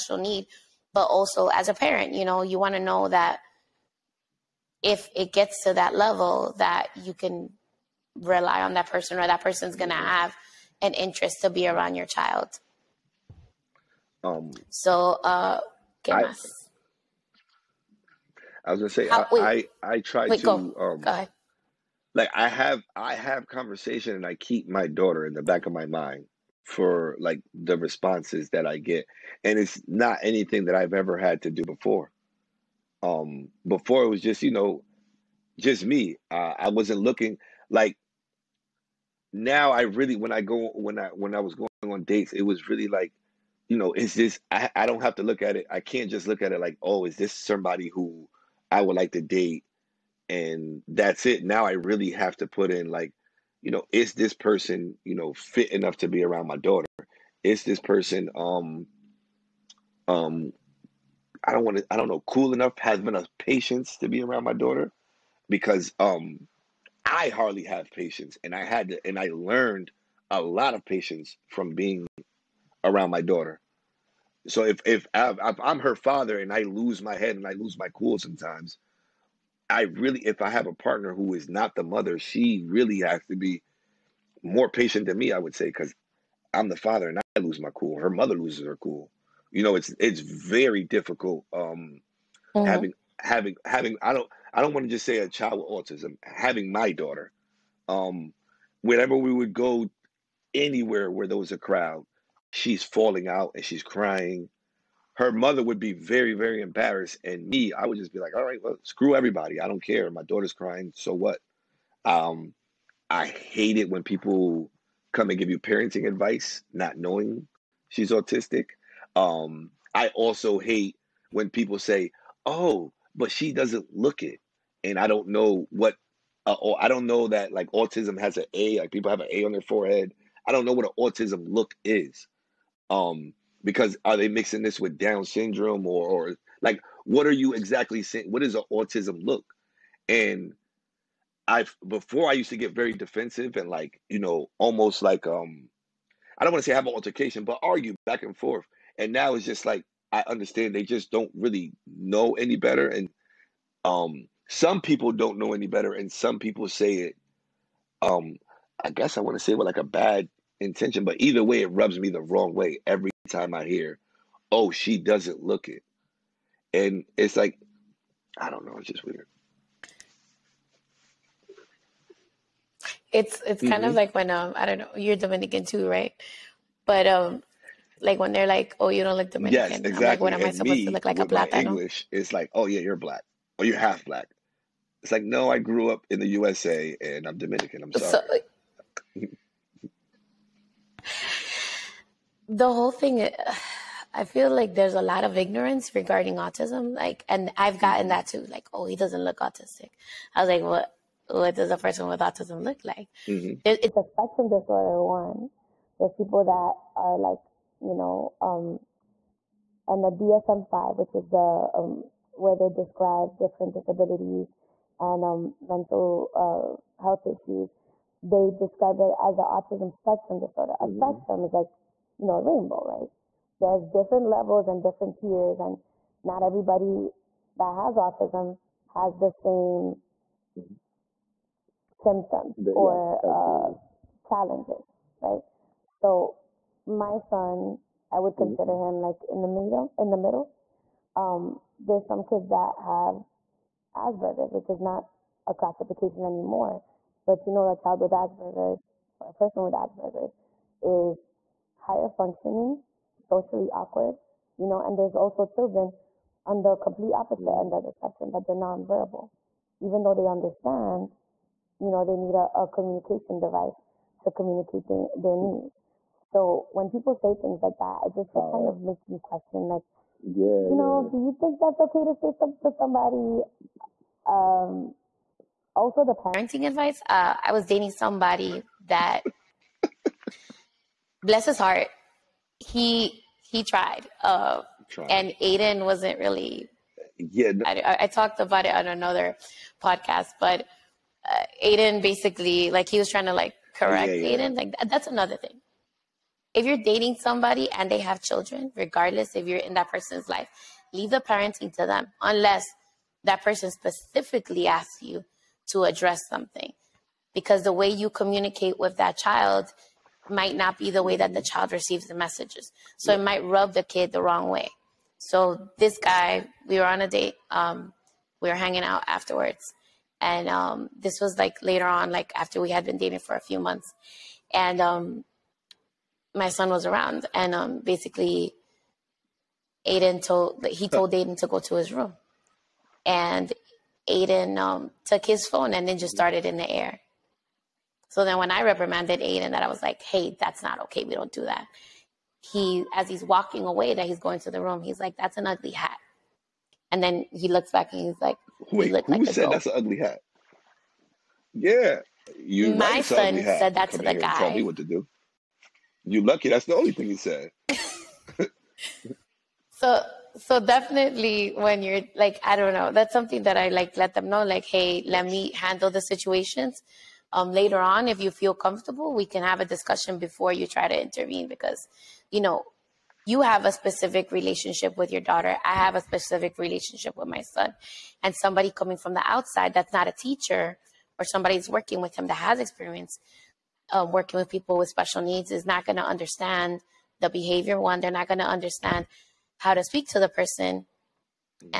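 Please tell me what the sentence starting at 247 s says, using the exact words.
But you know, a child with Asperger's or a person with Asperger's is higher functioning, socially awkward, you know.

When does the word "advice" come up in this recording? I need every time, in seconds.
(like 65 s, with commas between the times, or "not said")
116 s, 276 s.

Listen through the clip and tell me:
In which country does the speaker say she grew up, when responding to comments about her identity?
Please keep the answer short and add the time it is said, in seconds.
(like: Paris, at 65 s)
USA, at 186 s.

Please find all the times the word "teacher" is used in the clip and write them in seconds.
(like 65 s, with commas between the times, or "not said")
380 s.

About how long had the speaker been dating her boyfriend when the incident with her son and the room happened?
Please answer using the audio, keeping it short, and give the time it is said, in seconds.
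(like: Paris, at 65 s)
a few months, at 323 s.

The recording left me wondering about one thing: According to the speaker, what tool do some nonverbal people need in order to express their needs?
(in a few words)
communication device.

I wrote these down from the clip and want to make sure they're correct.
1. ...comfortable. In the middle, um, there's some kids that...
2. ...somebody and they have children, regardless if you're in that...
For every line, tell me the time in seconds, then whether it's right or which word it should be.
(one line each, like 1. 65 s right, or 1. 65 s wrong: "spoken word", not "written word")
1. 239 s wrong: "middle", not "comfortable"
2. 297 s right.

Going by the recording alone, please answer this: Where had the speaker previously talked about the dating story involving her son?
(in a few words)
another podcast.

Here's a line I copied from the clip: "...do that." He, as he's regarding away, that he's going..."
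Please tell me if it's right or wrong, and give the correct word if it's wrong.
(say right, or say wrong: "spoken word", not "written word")
wrong: "walking", not "regarding".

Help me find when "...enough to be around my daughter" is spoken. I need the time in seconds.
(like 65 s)
55 s.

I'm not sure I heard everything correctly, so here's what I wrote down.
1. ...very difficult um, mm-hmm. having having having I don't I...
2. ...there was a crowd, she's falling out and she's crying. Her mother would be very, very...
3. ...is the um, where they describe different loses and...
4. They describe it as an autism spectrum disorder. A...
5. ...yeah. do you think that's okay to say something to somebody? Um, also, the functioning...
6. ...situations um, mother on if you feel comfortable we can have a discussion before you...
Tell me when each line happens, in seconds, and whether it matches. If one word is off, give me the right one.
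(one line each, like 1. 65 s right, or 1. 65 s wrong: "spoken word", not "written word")
1. 90 s right
2. 101 s right
3. 211 s wrong: "disabilities", not "loses"
4. 218 s right
5. 271 s wrong: "parenting", not "functioning"
6. 365 s wrong: "later", not "mother".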